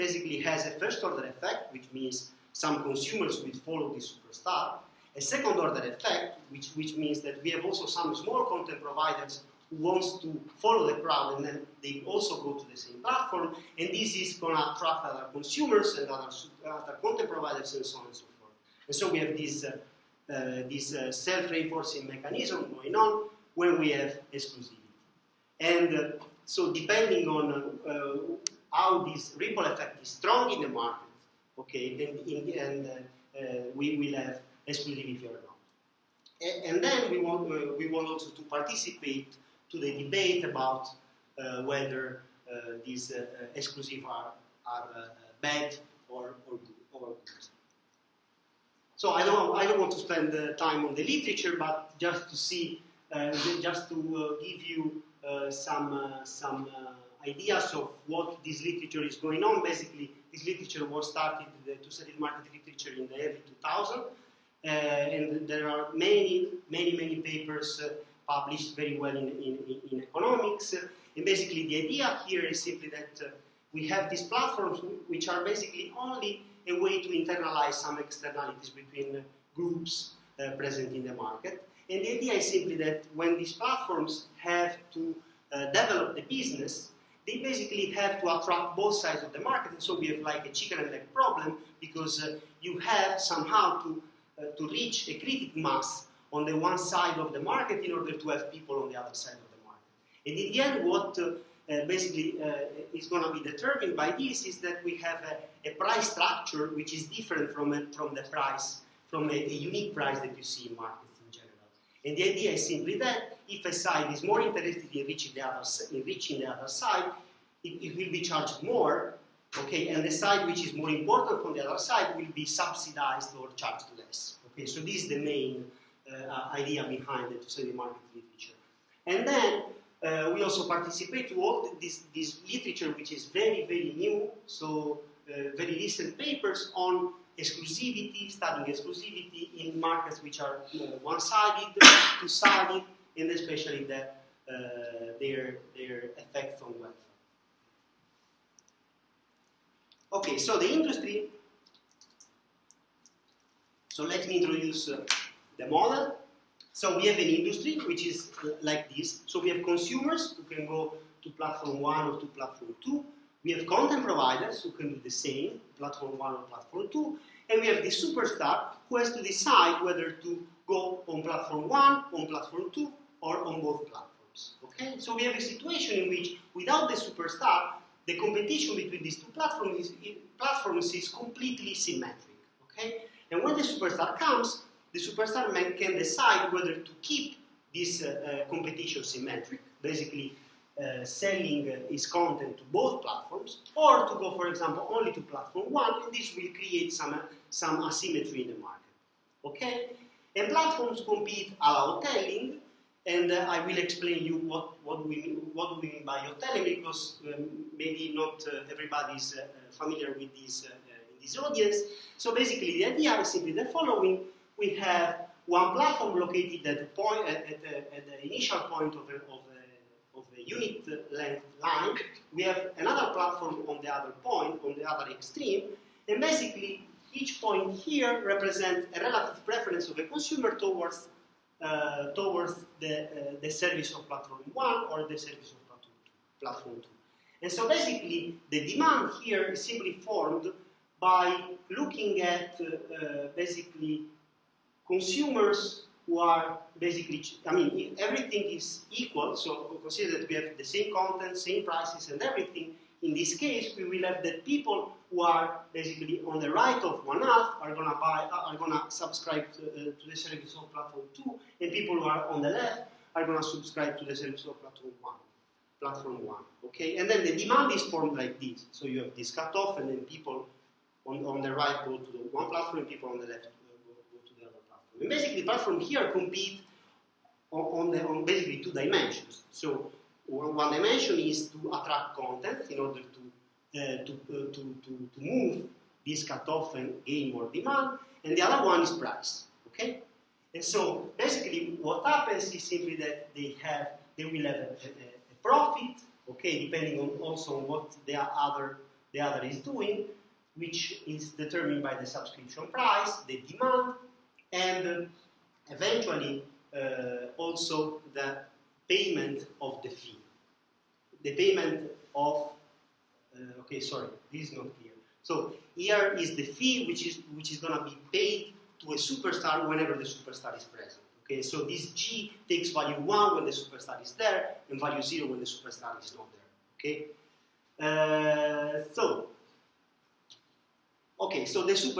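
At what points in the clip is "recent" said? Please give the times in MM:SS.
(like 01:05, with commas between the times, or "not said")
02:15.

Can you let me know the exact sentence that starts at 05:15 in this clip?
So here is the fee which is, which is going to be paid to a superstar whenever the superstar is present.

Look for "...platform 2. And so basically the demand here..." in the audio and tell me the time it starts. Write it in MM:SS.
03:56.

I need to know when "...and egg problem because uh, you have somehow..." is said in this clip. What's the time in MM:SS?
01:30.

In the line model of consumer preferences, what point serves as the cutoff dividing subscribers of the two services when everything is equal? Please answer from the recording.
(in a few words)
one half.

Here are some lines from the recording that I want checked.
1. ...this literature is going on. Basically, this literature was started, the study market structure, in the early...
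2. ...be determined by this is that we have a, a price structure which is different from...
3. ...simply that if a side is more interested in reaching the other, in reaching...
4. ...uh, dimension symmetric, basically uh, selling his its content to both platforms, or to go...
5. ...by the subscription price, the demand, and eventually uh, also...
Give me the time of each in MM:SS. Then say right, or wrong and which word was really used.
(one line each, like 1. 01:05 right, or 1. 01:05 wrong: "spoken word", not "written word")
1. 00:58 wrong: "literature", not "structure"
2. 01:43 right
3. 01:52 right
4. 03:08 wrong: "competition", not "dimension"
5. 05:01 right.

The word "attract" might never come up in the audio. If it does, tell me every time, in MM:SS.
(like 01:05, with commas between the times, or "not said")
00:14, 01:28, 04:41.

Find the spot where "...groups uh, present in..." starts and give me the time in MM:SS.
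01:19.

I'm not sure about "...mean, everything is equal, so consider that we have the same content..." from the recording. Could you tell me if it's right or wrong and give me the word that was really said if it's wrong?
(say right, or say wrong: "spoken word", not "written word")
right.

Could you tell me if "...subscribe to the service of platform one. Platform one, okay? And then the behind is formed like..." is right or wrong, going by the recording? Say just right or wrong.
wrong.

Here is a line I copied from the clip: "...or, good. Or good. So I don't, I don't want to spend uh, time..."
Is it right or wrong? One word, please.
right.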